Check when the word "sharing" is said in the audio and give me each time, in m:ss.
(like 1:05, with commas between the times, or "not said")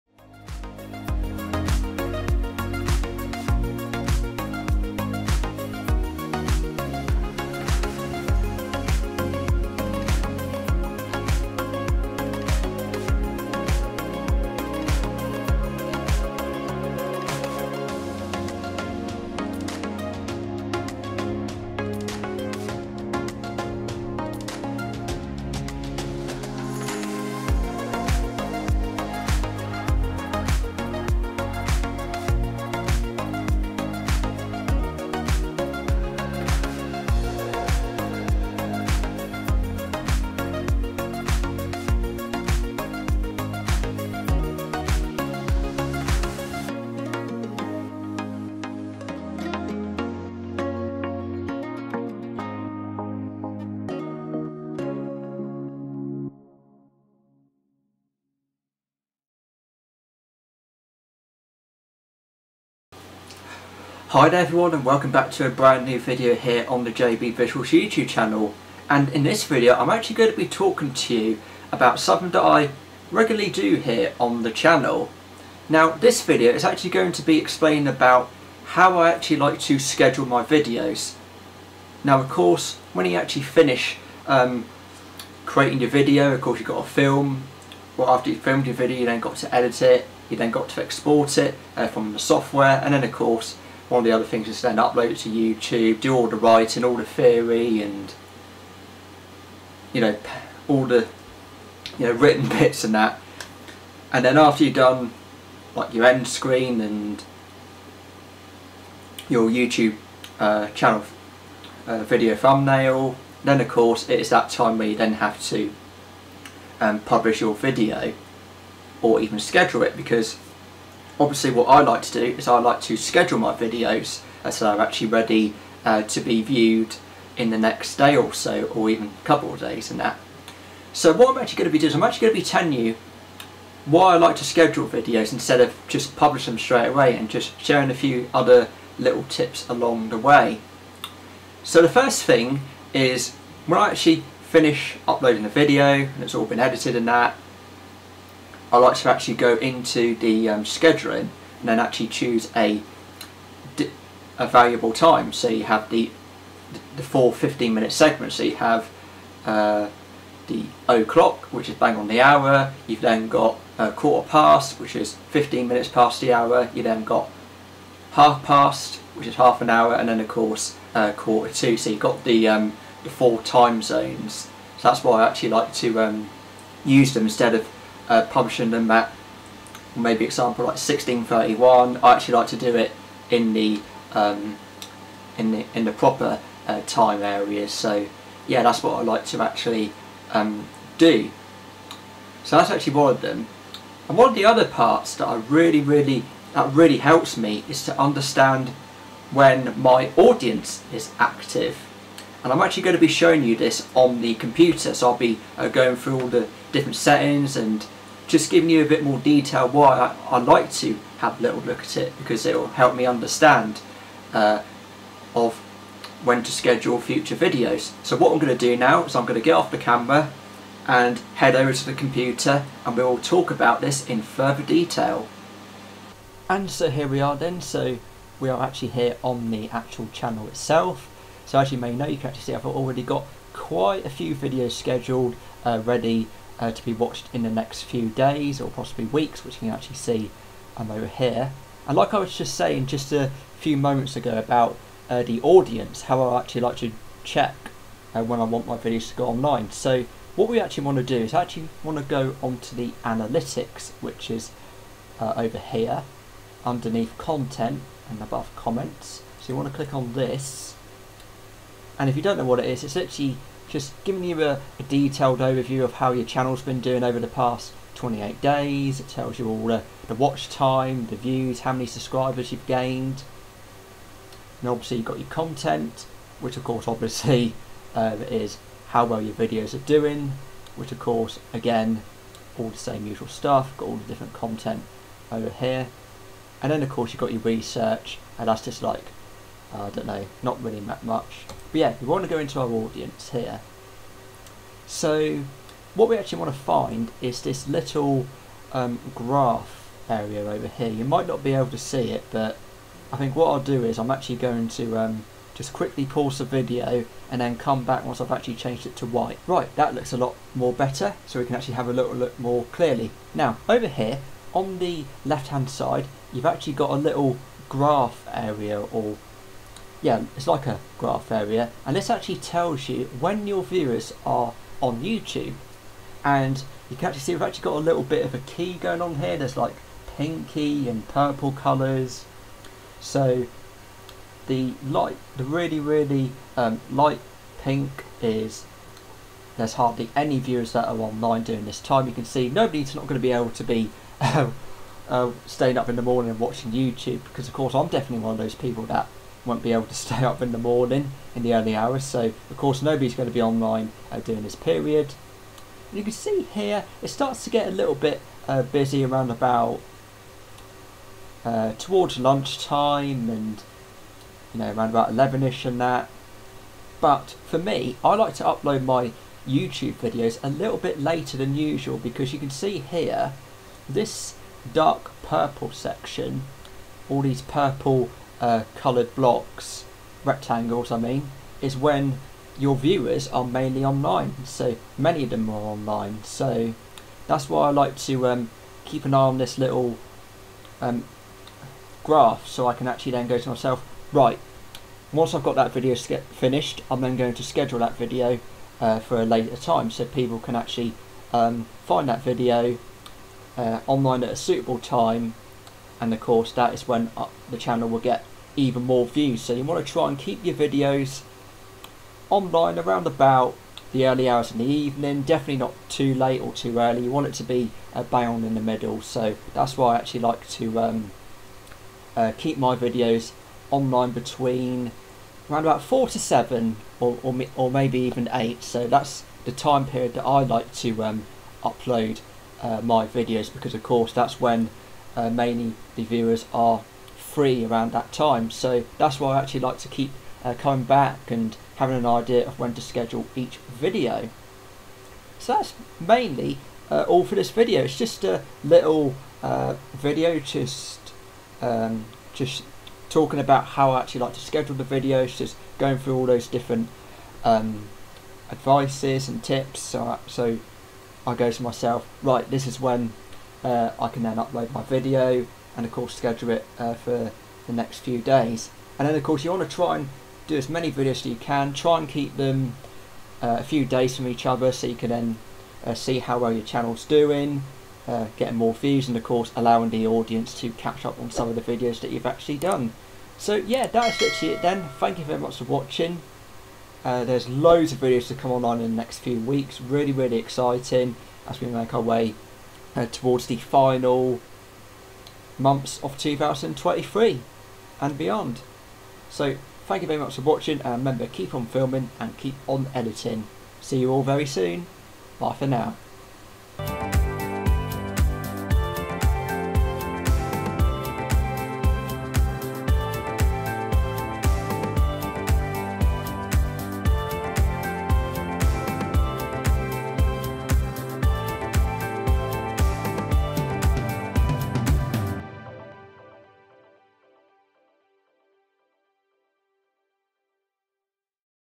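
2:17.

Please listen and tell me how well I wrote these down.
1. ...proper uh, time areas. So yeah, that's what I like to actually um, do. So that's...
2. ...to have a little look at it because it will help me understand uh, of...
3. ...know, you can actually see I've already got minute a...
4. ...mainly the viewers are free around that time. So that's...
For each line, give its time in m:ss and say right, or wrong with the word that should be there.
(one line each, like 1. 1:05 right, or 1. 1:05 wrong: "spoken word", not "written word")
1. 3:05 right
2. 3:30 right
3. 3:51 wrong: "quite", not "minute"
4. 7:15 right.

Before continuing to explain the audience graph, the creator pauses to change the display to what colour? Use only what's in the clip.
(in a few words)
white.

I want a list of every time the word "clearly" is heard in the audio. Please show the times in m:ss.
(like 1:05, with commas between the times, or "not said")
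5:12.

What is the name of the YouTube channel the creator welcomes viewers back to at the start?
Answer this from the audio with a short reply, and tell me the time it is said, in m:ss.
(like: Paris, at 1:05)
JB Visuals, at 1:06.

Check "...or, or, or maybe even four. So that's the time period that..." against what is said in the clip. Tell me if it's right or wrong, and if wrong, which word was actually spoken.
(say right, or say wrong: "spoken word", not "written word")
wrong: "eight", not "four".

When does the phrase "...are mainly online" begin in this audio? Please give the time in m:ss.
6:23.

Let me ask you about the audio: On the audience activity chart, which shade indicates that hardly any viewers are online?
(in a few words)
light pink.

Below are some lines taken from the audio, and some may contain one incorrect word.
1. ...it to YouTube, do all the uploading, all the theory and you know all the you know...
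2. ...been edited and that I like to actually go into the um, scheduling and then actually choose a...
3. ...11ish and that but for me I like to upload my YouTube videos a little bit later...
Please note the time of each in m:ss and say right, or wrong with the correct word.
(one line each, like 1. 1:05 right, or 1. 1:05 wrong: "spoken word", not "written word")
1. 1:35 wrong: "writing", not "uploading"
2. 2:26 right
3. 6:05 right.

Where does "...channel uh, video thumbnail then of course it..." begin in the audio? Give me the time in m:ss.
1:50.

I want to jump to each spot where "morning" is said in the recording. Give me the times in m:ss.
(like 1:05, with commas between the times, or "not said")
5:46, 5:50.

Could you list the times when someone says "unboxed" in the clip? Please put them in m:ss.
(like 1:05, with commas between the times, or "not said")
not said.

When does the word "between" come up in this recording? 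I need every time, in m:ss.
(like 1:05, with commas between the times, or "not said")
7:04.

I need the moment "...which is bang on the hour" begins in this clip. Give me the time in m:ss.
2:41.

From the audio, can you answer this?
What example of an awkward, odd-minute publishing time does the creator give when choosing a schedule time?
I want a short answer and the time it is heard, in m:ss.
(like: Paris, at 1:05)
1631, at 3:00.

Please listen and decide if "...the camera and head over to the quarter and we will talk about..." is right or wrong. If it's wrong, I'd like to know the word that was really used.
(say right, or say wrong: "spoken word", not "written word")
wrong: "computer", not "quarter".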